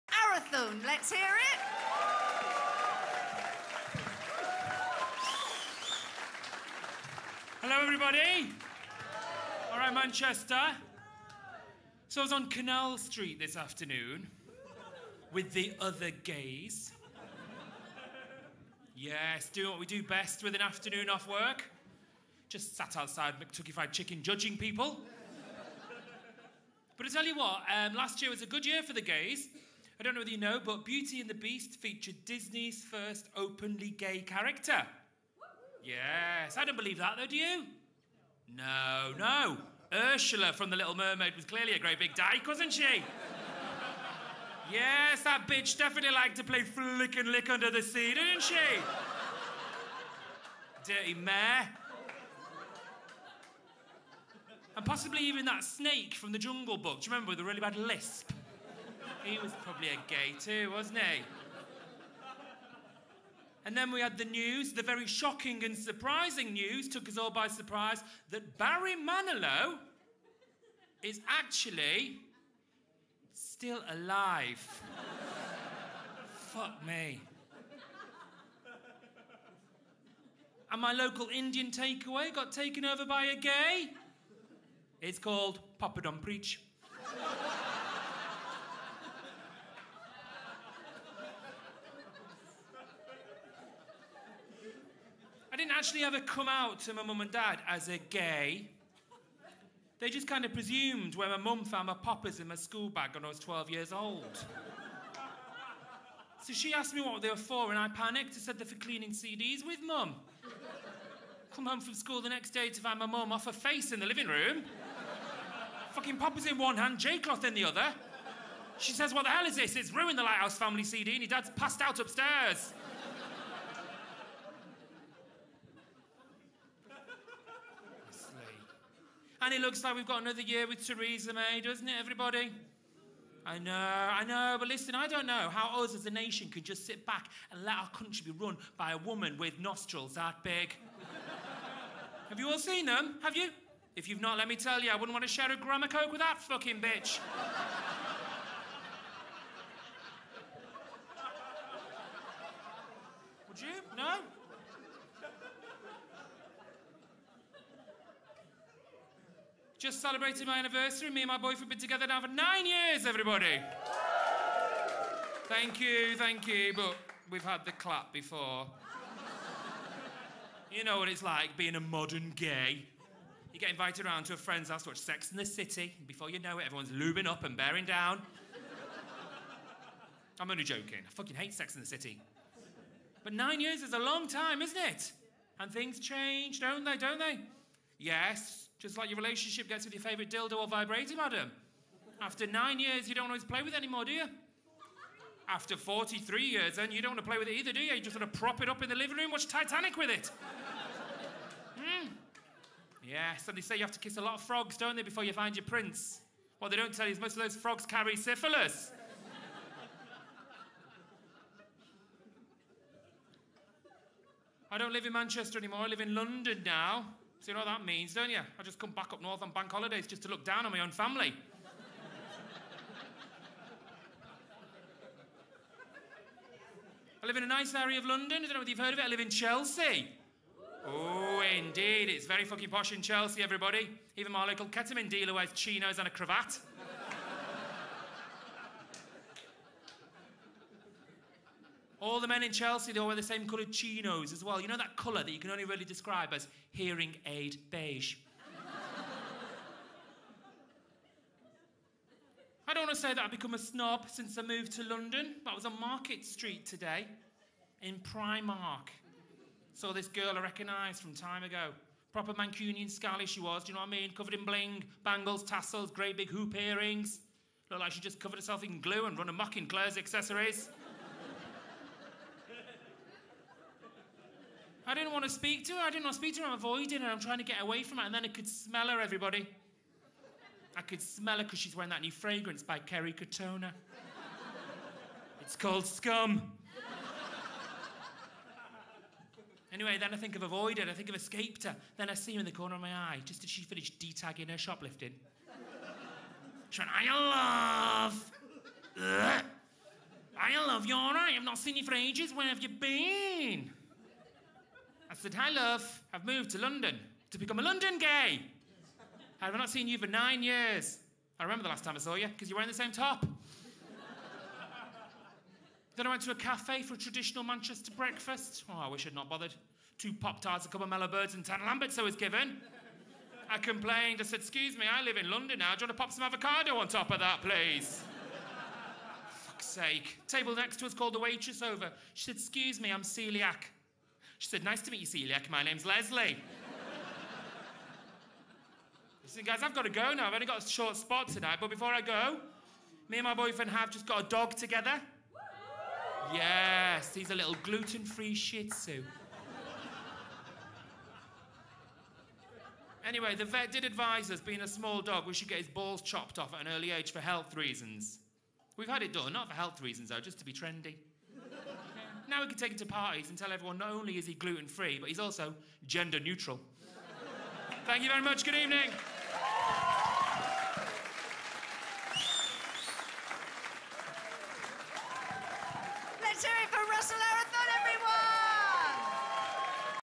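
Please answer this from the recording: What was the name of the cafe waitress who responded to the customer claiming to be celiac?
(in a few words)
Leslie.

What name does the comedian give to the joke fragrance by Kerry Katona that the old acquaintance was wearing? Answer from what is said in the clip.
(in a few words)
Scum.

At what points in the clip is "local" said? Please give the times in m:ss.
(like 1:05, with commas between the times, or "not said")
1:20, 3:54.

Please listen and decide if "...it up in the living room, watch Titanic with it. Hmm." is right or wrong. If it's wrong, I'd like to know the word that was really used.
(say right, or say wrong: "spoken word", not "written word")
right.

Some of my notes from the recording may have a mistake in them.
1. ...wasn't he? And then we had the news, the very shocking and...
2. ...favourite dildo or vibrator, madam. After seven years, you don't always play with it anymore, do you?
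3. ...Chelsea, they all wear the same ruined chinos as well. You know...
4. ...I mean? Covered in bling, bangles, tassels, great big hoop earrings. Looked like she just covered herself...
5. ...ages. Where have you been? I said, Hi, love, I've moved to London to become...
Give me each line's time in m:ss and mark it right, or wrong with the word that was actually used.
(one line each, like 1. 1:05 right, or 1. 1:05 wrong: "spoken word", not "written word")
1. 1:00 right
2. 3:10 wrong: "nine", not "seven"
3. 4:02 wrong: "coloured", not "ruined"
4. 4:23 right
5. 5:01 right.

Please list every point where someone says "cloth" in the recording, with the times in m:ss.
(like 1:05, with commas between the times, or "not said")
1:56.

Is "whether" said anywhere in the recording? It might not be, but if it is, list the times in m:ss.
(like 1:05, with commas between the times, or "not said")
0:30, 3:48.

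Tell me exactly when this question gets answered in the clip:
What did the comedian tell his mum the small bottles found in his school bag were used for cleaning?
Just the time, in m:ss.
1:48.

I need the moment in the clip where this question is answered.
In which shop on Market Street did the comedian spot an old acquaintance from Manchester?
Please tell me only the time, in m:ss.
4:17.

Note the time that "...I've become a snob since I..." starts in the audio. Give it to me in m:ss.
4:13.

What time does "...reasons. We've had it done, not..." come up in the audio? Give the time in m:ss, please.
5:57.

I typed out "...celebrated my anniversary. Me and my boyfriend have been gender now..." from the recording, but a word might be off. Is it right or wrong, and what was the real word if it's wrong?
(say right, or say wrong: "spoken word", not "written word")
wrong: "together", not "gender".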